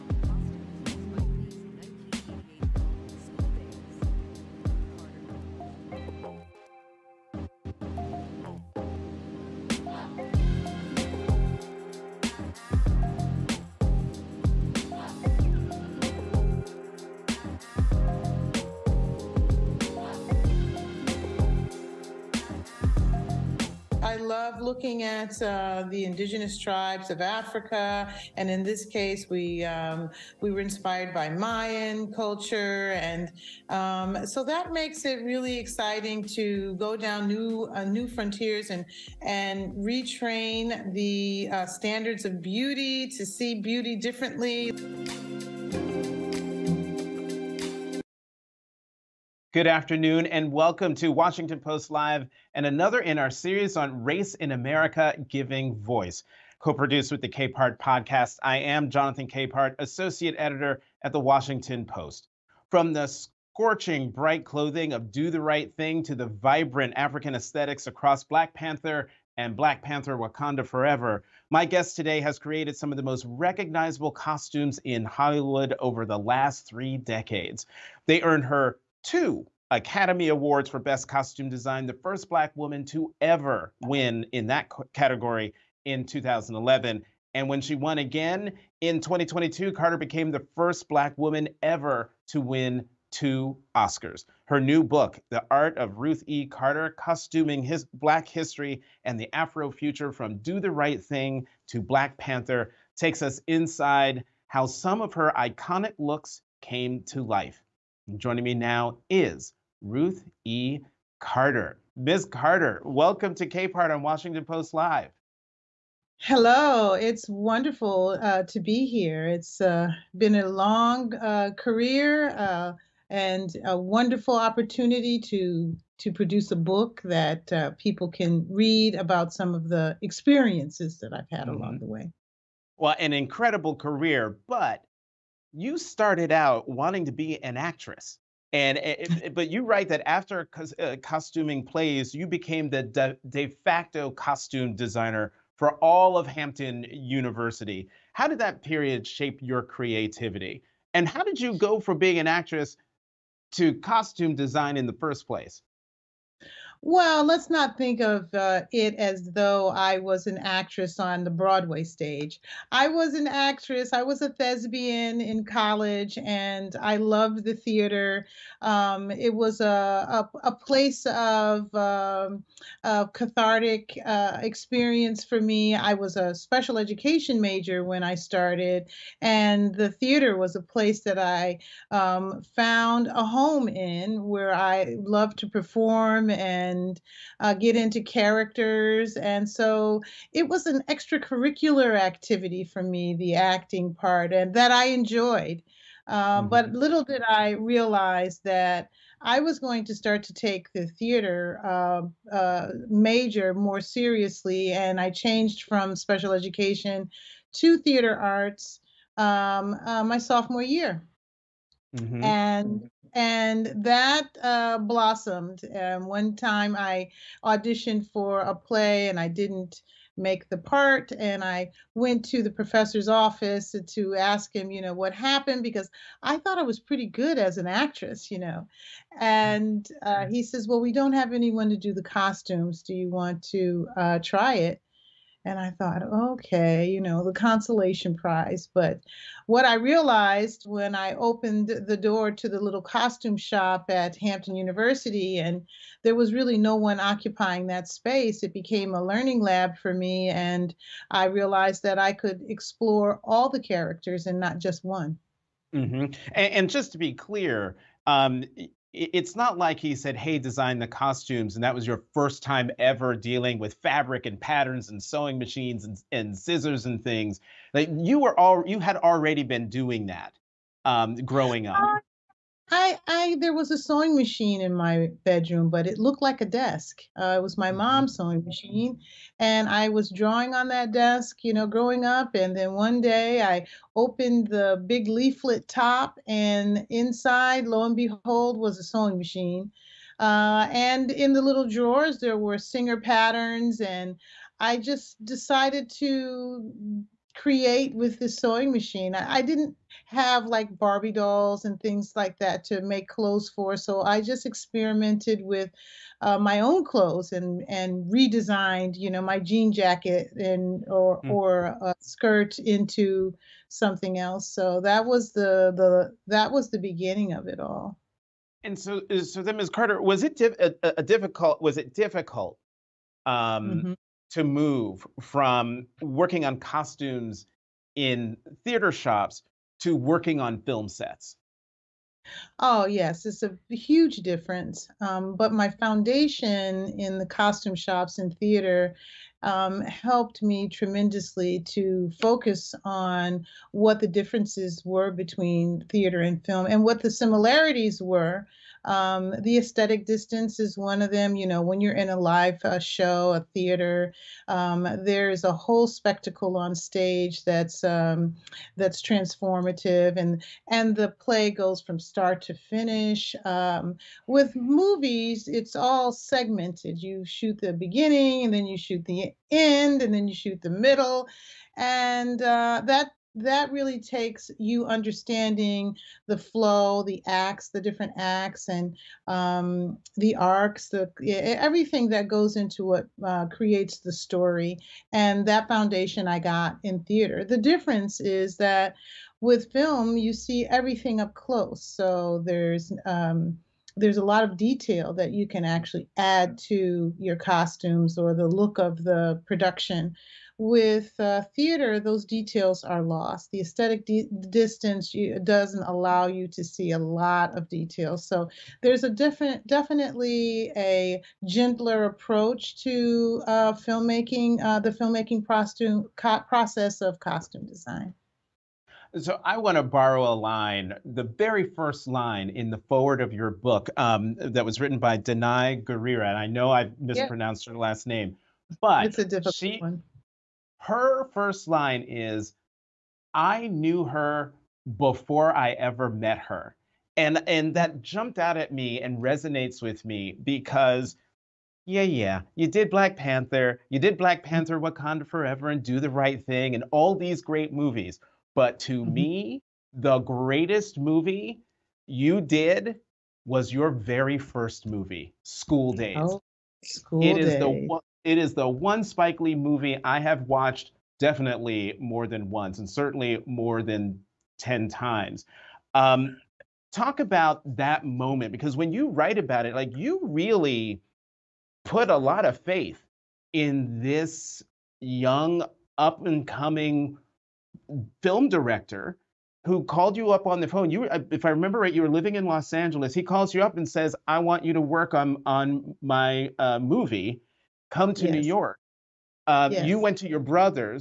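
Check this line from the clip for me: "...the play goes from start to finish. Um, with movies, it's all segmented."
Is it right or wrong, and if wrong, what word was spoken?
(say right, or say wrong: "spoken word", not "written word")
right.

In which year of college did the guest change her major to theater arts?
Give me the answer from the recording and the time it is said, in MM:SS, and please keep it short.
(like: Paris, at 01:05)
Sophomore year, at 03:30.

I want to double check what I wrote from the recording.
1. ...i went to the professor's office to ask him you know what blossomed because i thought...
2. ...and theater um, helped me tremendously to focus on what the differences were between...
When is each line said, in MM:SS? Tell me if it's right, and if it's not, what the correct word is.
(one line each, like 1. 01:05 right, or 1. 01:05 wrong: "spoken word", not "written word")
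1. 03:41 wrong: "happened", not "blossomed"
2. 05:38 right.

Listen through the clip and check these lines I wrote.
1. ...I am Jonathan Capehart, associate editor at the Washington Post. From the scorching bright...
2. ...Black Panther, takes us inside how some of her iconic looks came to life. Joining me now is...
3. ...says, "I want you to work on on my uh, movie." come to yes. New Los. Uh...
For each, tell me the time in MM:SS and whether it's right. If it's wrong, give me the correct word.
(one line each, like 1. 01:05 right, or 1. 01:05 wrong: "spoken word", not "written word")
1. 00:58 right
2. 01:41 right
3. 08:03 wrong: "York", not "Los".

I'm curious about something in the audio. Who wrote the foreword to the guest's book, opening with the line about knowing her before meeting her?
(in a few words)
Danai Gurira.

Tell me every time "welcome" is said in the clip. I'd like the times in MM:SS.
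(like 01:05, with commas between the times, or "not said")
00:50, 01:52.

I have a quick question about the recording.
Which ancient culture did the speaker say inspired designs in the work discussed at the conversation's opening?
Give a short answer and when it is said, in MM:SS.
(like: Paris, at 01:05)
Mayan culture, at 00:31.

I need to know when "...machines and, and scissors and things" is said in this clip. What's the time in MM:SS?
04:25.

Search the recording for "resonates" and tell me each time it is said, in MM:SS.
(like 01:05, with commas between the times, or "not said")
07:19.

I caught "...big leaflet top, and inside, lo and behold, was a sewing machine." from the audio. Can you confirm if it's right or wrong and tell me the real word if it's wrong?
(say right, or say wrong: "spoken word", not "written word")
right.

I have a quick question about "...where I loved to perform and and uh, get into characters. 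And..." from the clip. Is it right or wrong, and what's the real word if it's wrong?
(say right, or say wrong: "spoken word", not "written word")
right.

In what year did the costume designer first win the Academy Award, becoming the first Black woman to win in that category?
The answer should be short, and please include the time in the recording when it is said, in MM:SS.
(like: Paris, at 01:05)
2011, at 01:26.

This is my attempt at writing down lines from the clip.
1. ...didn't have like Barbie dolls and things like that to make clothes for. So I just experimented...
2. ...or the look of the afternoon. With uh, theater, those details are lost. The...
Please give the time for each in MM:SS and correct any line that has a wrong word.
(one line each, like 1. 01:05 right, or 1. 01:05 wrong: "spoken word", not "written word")
1. 04:59 right
2. 06:38 wrong: "production", not "afternoon".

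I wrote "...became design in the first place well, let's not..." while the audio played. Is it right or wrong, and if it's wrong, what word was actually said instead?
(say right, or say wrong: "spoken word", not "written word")
wrong: "costume", not "became".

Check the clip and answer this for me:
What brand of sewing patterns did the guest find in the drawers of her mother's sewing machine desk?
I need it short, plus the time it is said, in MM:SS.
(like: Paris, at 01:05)
Singer, at 04:52.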